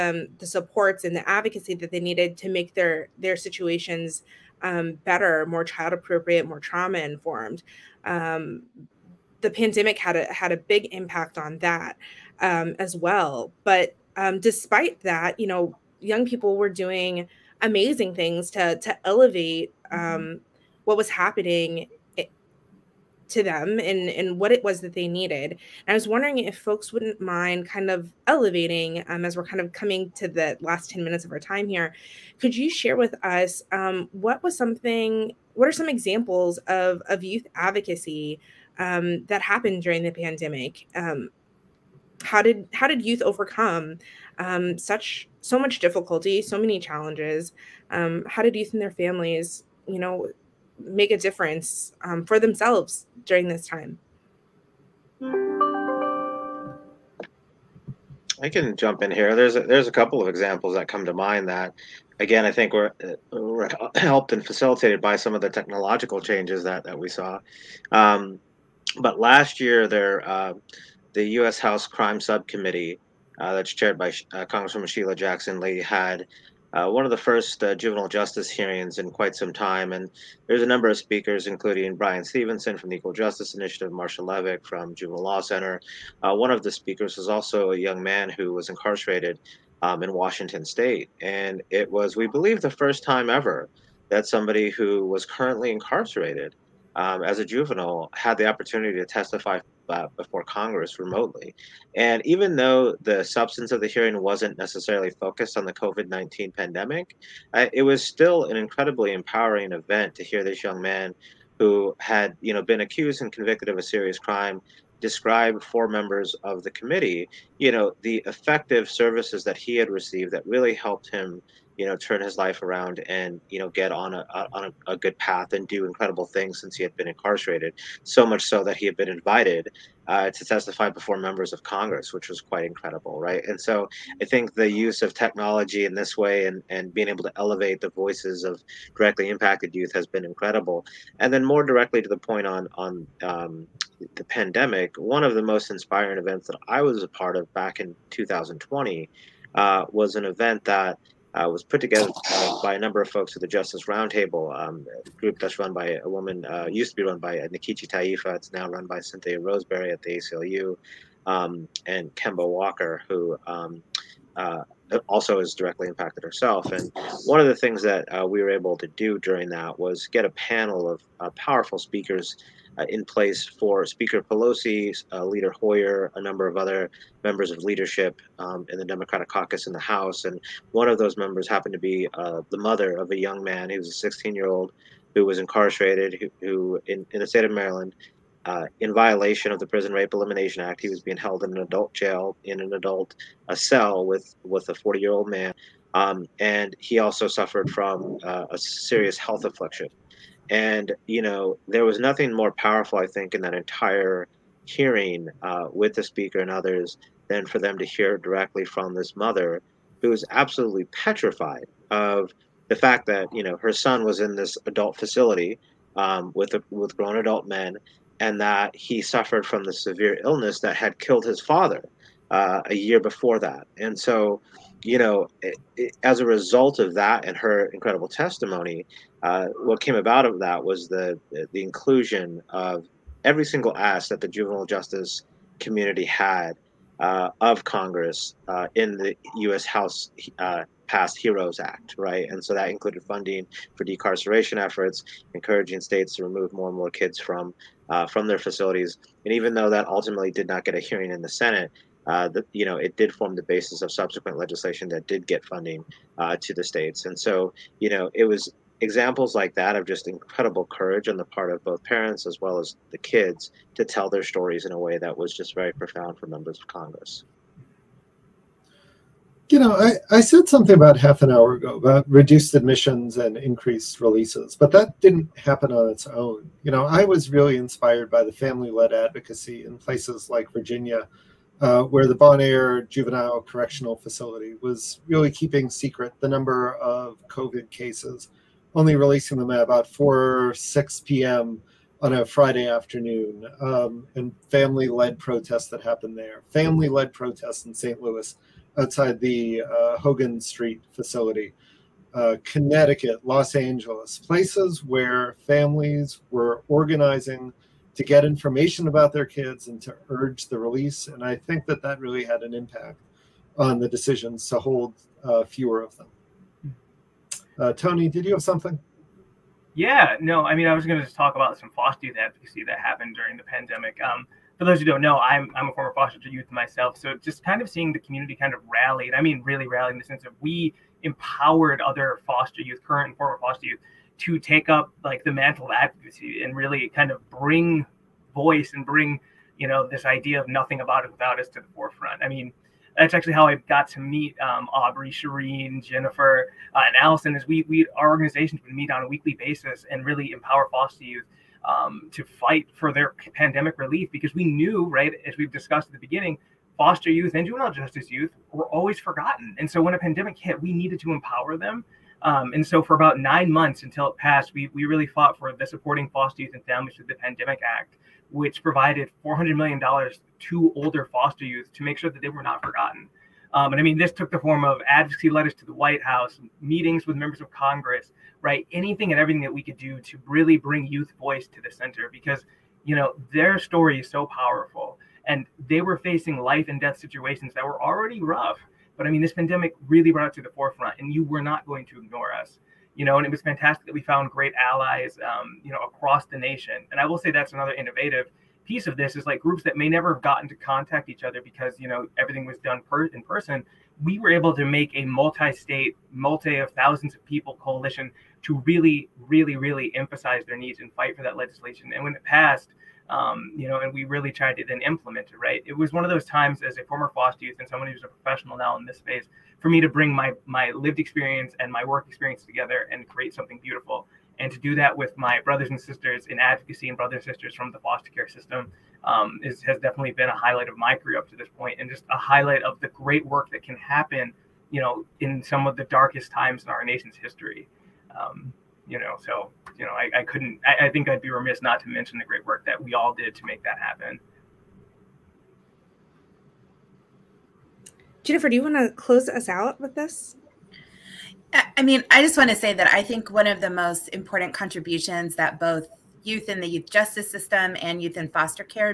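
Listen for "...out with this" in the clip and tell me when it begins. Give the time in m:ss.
7:29.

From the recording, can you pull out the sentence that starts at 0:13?
But um, despite that, you know, young people were doing amazing things to to elevate mm-hmm.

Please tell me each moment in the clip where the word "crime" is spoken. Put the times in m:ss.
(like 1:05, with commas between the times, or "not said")
1:11, 1:54.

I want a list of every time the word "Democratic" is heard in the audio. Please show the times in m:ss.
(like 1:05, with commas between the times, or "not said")
2:58.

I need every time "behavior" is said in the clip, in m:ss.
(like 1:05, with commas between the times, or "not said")
not said.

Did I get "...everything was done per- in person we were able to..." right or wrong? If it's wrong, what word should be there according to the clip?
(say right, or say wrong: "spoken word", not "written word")
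right.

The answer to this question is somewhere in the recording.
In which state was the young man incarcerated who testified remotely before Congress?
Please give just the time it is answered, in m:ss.
1:30.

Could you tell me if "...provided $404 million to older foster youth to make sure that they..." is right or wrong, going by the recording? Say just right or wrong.
wrong.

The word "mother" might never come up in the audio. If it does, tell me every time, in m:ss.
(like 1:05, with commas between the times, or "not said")
3:02, 3:29.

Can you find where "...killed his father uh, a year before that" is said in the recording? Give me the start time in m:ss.
3:40.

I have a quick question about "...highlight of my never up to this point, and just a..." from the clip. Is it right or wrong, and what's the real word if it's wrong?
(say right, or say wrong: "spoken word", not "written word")
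wrong: "career", not "never".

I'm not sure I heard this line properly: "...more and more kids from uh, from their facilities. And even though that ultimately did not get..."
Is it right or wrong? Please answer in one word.
right.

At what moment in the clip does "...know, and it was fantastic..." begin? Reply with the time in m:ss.
6:33.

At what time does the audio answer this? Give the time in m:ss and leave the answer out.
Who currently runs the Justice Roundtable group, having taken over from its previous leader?
2:39.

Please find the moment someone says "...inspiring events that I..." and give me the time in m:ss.
2:25.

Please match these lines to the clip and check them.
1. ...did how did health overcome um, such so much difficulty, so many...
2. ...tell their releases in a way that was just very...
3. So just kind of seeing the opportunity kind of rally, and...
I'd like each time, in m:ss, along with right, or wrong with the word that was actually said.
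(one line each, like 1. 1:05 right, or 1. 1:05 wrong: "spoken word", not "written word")
1. 0:42 wrong: "youth", not "health"
2. 4:23 wrong: "stories", not "releases"
3. 5:26 wrong: "community", not "opportunity".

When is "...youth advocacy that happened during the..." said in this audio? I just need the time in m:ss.
5:22.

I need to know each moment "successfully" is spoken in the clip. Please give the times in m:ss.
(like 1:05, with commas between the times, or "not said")
not said.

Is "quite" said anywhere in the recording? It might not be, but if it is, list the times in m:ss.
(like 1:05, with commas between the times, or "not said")
1:19, 2:12.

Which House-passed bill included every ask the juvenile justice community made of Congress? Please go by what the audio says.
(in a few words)
Heroes Act.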